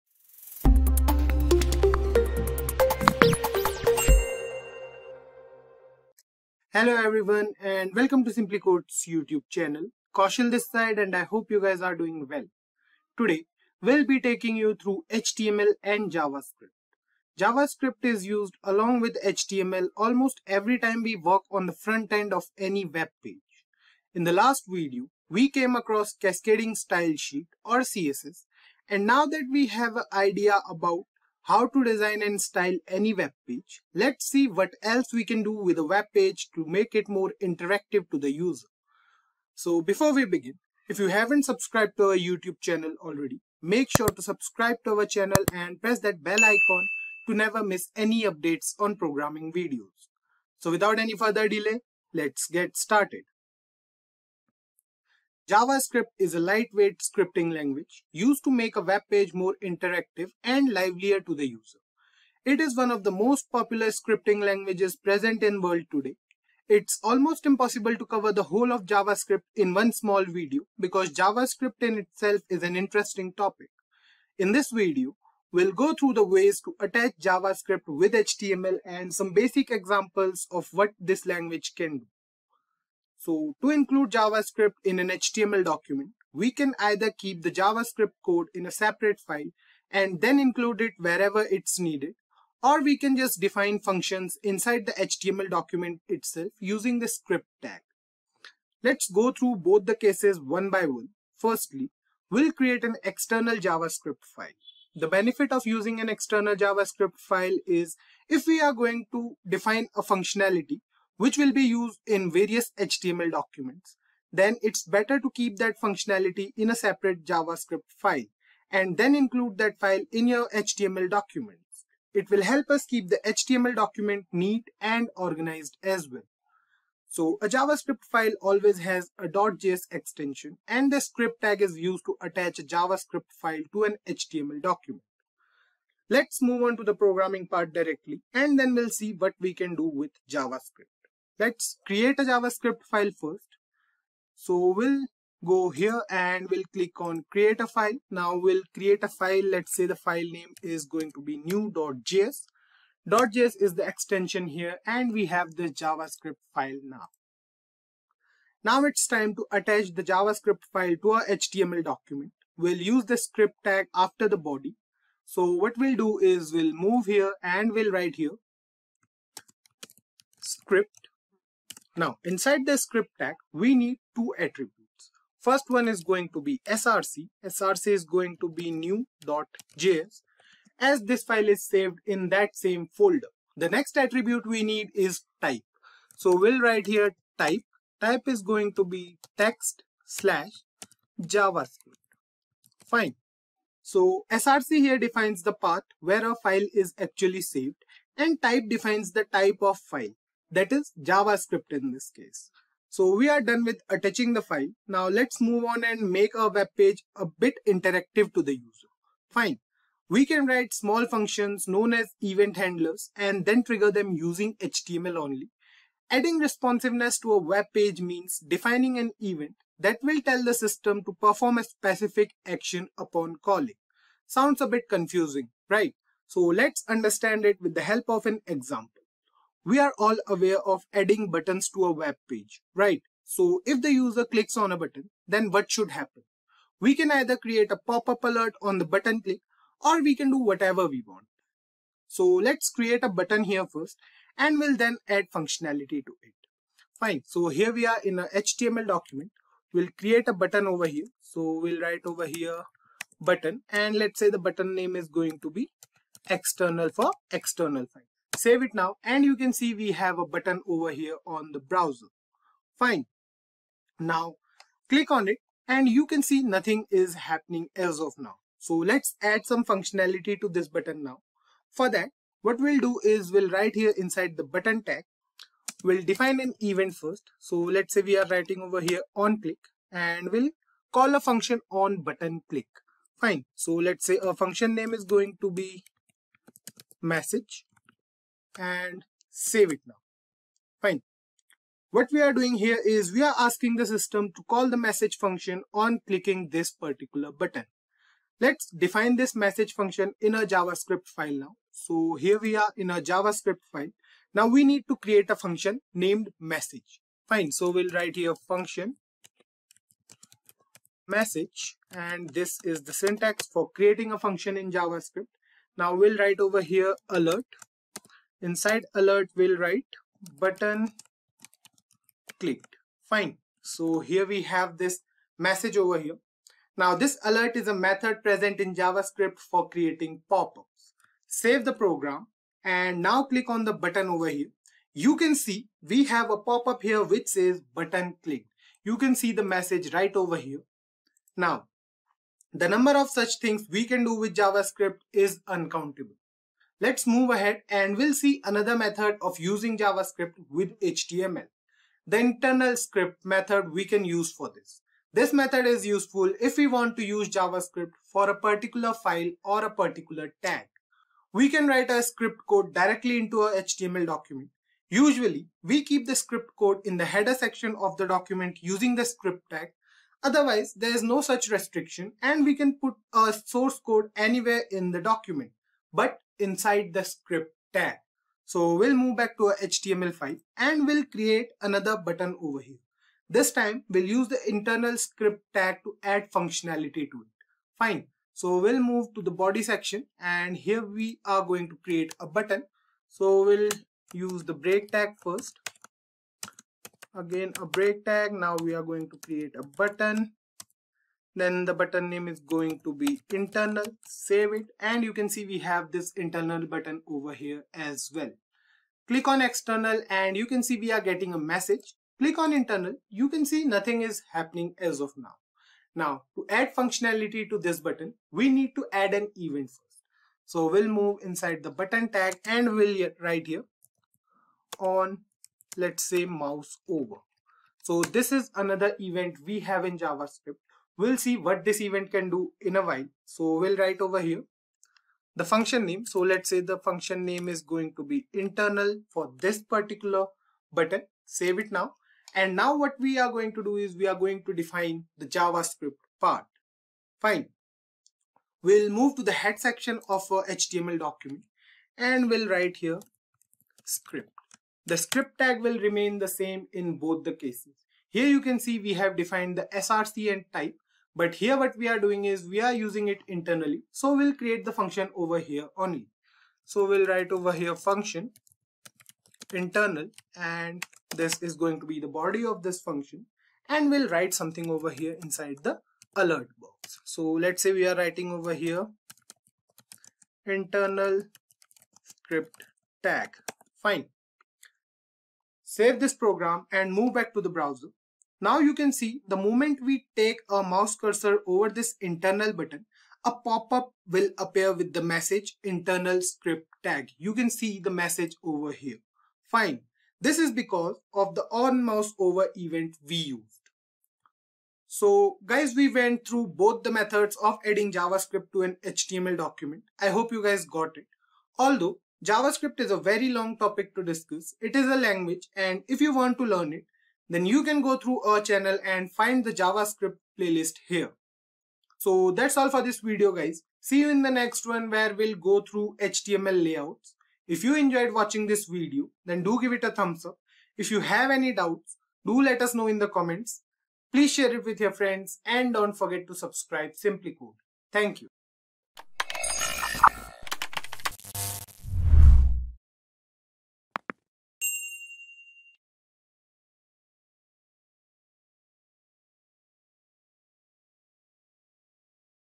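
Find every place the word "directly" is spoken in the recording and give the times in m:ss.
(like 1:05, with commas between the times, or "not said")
2:17, 6:02.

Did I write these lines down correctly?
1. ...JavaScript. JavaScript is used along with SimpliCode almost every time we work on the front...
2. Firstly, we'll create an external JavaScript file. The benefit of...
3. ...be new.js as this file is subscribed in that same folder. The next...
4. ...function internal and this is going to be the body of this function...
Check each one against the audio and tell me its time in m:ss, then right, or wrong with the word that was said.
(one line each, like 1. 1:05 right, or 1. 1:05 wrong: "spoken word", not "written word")
1. 0:16 wrong: "HTML", not "SimpliCode"
2. 1:41 right
3. 2:58 wrong: "saved", not "subscribed"
4. 7:47 right.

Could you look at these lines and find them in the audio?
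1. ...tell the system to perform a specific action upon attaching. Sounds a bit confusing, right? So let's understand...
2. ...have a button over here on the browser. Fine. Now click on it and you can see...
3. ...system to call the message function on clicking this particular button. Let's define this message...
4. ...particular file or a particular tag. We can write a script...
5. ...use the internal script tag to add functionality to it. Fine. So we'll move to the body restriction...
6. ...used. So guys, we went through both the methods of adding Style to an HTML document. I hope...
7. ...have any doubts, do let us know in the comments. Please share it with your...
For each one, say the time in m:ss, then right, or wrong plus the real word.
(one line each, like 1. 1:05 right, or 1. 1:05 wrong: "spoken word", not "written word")
1. 3:40 wrong: "calling", not "attaching"
2. 4:19 right
3. 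4:53 right
4. 5:58 right
5. 6:24 wrong: "section", not "restriction"
6. 8:23 wrong: "JavaScript", not "Style"
7. 8:51 right.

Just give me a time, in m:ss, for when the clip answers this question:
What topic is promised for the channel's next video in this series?
8:46.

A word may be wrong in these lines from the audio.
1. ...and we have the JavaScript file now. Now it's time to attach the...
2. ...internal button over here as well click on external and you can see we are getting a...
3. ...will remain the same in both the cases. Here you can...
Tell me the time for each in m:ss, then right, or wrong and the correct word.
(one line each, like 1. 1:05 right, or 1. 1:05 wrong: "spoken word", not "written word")
1. 2:34 right
2. 6:46 right
3. 7:35 right.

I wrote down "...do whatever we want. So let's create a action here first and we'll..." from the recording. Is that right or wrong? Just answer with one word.
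wrong.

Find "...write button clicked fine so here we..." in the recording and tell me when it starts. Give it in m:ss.
5:19.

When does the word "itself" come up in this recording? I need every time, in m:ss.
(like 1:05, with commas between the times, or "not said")
1:11, 1:36.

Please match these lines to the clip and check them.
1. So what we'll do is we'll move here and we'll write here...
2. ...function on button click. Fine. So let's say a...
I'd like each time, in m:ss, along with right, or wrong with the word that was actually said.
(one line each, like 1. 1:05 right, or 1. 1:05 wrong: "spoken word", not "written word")
1. 2:45 right
2. 4:41 right.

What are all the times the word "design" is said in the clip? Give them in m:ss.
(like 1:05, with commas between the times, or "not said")
0:31.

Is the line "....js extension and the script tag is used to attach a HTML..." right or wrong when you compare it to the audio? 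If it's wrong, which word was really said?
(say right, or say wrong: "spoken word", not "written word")
wrong: "JavaScript", not "HTML".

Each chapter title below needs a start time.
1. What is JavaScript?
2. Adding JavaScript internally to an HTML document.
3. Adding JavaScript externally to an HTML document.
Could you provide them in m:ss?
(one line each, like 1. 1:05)
1. 0:55
2. 5:46
3. 2:21.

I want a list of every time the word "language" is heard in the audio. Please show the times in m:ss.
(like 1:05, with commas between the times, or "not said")
0:57, 1:04, 1:21, 8:34.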